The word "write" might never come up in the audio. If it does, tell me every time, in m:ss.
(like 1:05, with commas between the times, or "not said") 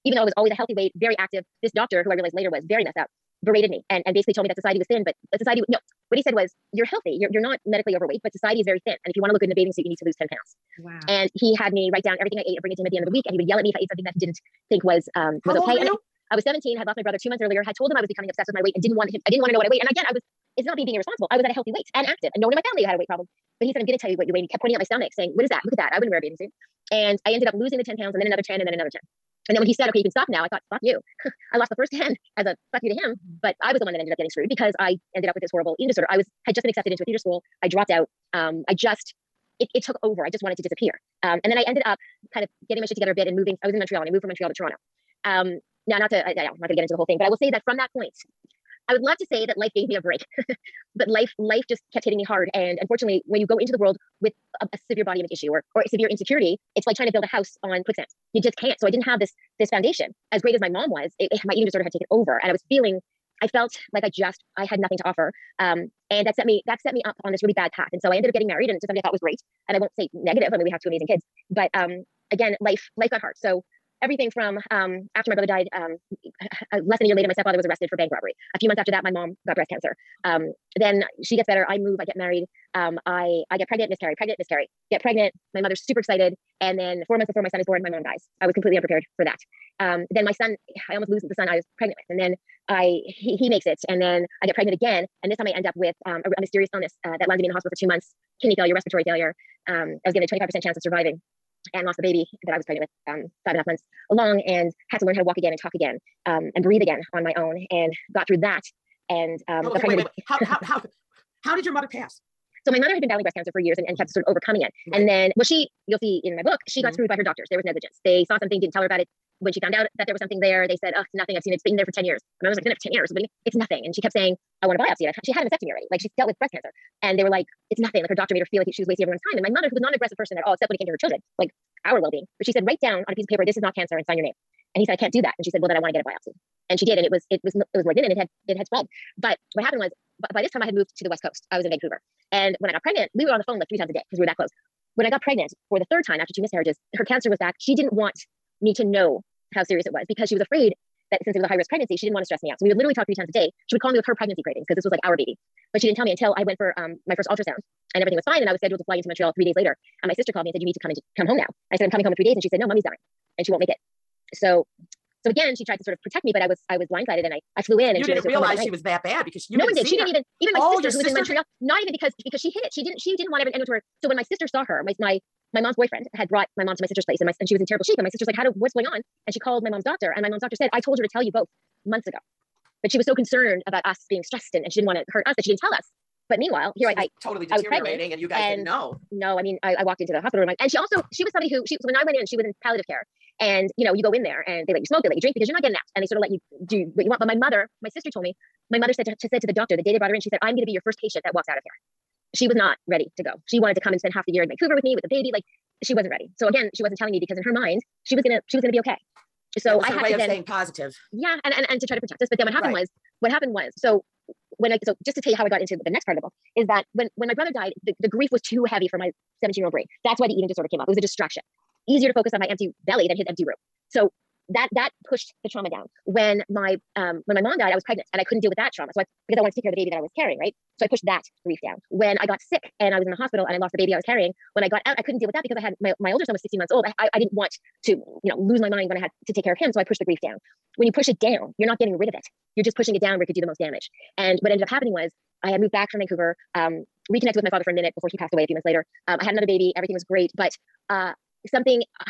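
0:11, 2:12.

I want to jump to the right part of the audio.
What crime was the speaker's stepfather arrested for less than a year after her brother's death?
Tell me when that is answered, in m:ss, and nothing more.
1:17.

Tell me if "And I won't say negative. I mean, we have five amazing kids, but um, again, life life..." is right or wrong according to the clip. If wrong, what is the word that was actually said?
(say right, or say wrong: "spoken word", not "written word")
wrong: "two", not "five".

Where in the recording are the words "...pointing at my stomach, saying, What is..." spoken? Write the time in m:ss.
0:24.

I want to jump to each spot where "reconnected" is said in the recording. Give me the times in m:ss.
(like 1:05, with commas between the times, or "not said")
4:07.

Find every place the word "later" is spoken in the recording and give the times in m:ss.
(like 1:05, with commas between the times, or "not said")
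0:02, 1:17, 2:39, 4:08.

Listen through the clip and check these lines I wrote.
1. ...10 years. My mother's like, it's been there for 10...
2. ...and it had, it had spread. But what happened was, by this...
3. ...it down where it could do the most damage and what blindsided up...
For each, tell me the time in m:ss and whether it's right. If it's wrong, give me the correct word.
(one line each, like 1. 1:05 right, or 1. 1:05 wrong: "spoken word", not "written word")
1. 2:01 right
2. 2:18 right
3. 4:02 wrong: "ended", not "blindsided".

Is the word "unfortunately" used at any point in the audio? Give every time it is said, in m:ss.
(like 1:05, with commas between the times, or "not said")
0:52.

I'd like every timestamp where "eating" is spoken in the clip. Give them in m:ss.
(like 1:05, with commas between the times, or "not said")
0:35, 1:01, 3:40.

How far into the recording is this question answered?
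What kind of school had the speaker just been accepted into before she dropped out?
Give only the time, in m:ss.
0:37.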